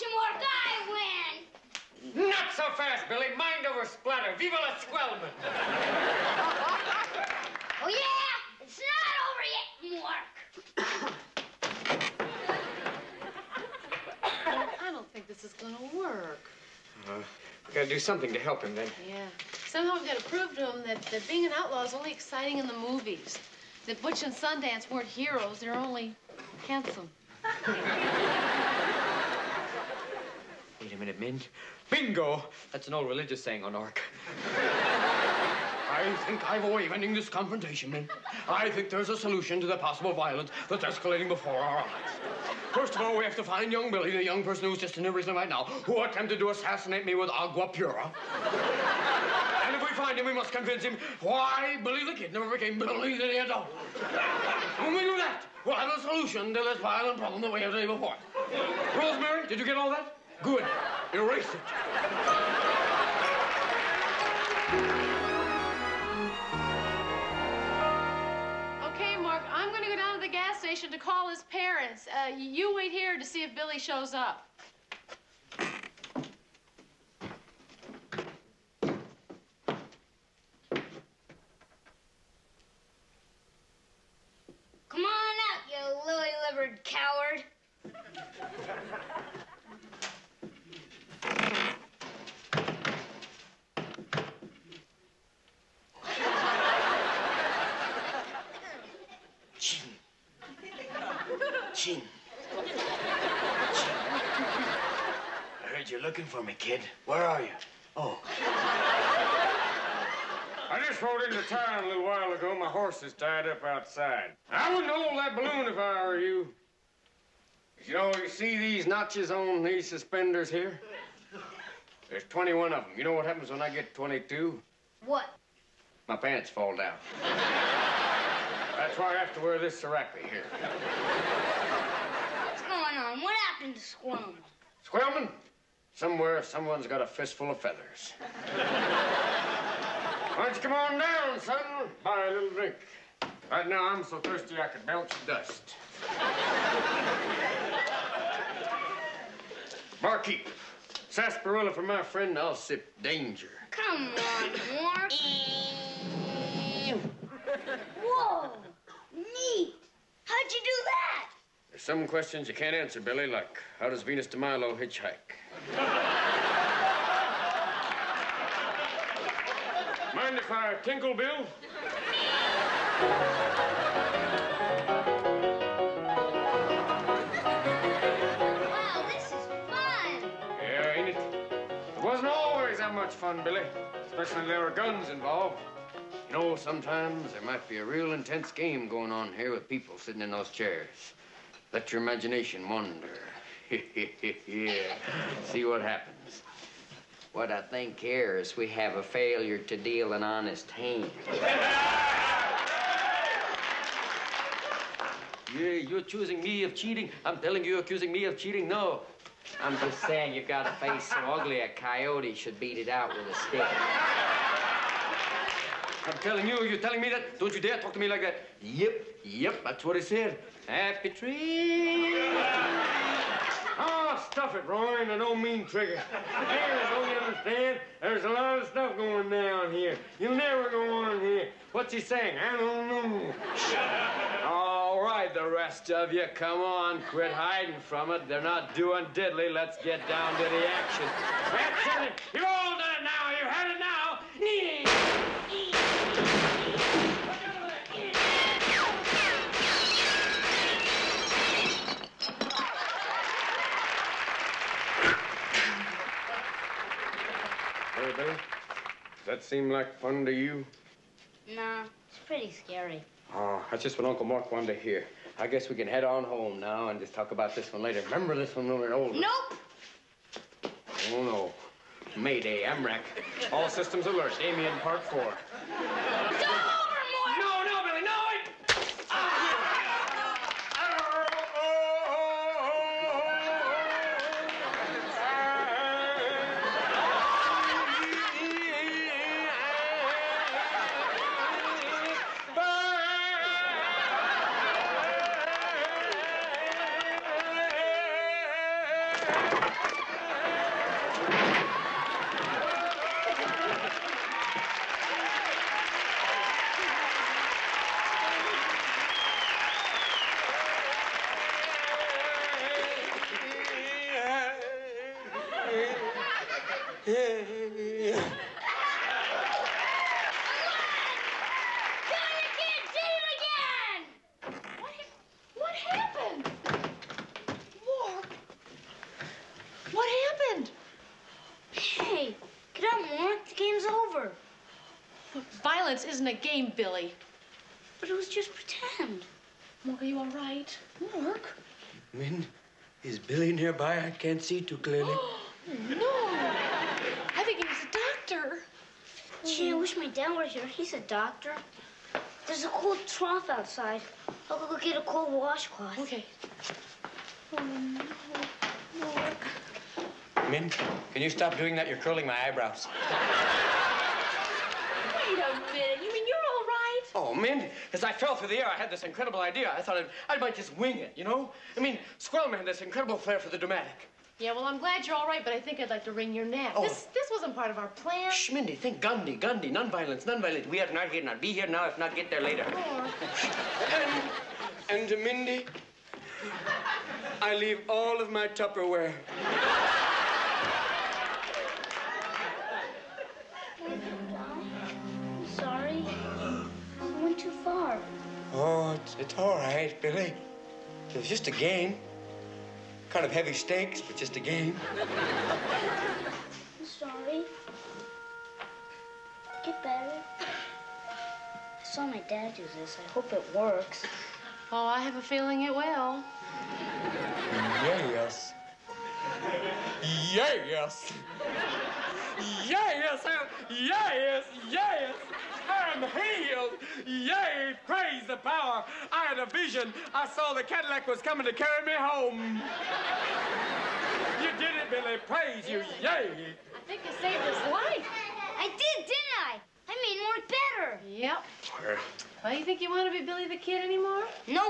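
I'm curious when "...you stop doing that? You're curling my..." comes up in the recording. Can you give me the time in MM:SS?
06:01.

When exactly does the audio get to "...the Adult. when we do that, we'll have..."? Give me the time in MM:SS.
00:53.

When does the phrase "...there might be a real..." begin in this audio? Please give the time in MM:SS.
03:07.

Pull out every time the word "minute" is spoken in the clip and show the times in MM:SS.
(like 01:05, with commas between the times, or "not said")
00:30, 06:05.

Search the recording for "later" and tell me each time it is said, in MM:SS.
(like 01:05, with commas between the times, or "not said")
04:27, 06:22.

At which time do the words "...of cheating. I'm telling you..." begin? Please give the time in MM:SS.
03:26.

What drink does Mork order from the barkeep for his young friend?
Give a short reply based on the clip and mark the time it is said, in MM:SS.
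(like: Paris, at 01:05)
sarsaparilla, at 02:31.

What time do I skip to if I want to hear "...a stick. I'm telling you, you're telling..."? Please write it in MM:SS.
03:33.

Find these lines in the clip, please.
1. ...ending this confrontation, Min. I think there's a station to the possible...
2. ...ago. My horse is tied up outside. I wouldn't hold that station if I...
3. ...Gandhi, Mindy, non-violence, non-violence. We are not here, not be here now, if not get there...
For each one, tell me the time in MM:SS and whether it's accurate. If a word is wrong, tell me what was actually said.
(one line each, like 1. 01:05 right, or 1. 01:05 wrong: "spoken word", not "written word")
1. 00:36 wrong: "solution", not "station"
2. 01:52 wrong: "balloon", not "station"
3. 06:19 wrong: "Gandhi", not "Mindy".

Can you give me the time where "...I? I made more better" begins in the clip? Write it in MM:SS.
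07:19.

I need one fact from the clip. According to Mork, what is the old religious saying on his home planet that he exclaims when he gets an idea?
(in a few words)
Bingo.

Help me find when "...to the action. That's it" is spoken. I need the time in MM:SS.
04:00.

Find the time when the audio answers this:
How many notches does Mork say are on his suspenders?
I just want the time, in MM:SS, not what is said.
02:02.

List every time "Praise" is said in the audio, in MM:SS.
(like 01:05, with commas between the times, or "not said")
07:07, 07:15.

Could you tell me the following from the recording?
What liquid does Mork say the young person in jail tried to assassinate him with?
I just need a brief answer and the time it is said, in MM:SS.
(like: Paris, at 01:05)
agua pura, at 00:47.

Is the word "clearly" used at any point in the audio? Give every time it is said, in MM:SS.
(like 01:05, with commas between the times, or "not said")
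05:44.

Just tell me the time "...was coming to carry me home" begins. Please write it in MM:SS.
07:11.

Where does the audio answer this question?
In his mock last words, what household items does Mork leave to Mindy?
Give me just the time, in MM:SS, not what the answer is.
06:28.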